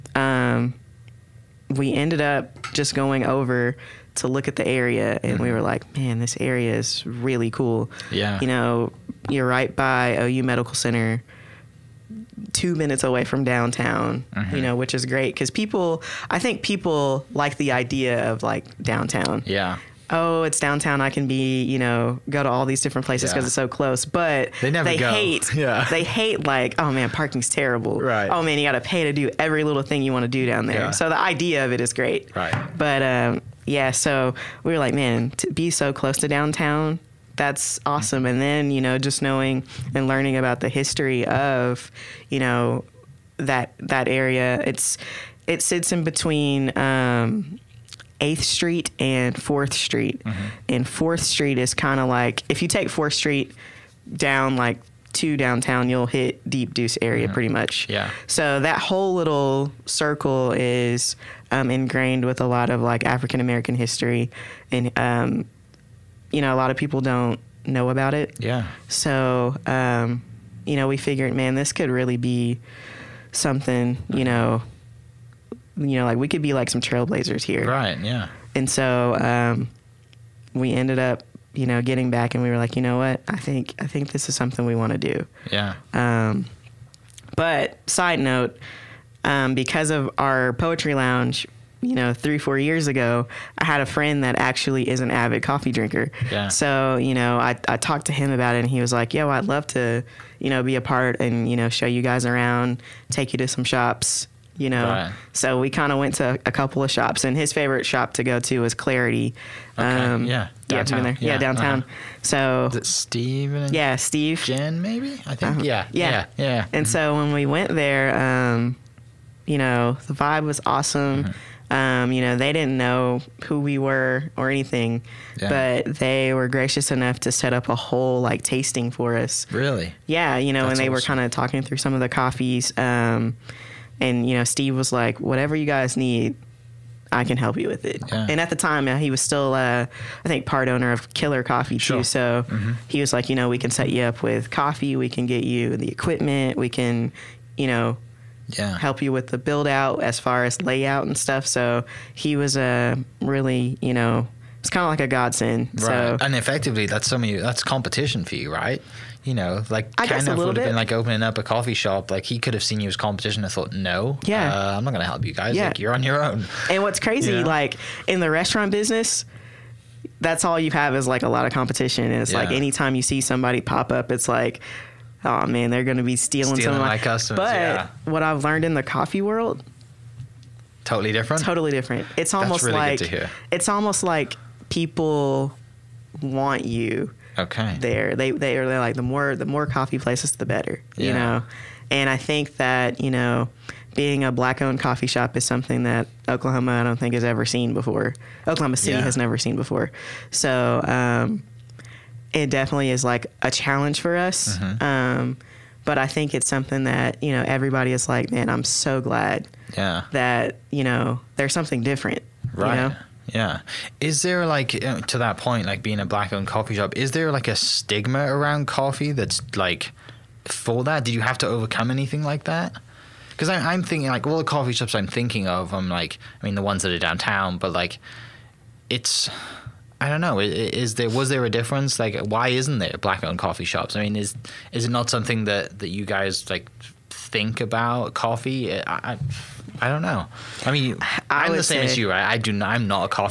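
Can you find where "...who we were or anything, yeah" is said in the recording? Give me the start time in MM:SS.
02:03.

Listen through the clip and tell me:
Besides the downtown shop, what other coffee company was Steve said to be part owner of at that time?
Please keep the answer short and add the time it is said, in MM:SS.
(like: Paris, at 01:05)
Killer Coffee, at 02:21.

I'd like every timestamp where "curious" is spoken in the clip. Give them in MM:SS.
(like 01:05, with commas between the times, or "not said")
not said.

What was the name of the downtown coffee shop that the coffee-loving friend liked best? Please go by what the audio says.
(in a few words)
Clarity.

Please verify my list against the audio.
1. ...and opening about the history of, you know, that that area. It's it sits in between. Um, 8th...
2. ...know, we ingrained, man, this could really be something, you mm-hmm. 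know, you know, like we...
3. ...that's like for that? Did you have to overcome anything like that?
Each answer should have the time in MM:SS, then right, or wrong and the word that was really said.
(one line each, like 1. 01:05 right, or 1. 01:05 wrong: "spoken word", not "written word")
1. 00:39 wrong: "learning", not "opening"
2. 01:10 wrong: "figured", not "ingrained"
3. 03:39 right.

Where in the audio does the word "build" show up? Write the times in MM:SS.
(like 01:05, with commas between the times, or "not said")
02:29.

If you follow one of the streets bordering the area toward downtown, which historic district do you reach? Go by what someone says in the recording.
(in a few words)
Deep Deuce.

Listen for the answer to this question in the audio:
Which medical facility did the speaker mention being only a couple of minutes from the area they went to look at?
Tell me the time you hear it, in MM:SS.
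00:10.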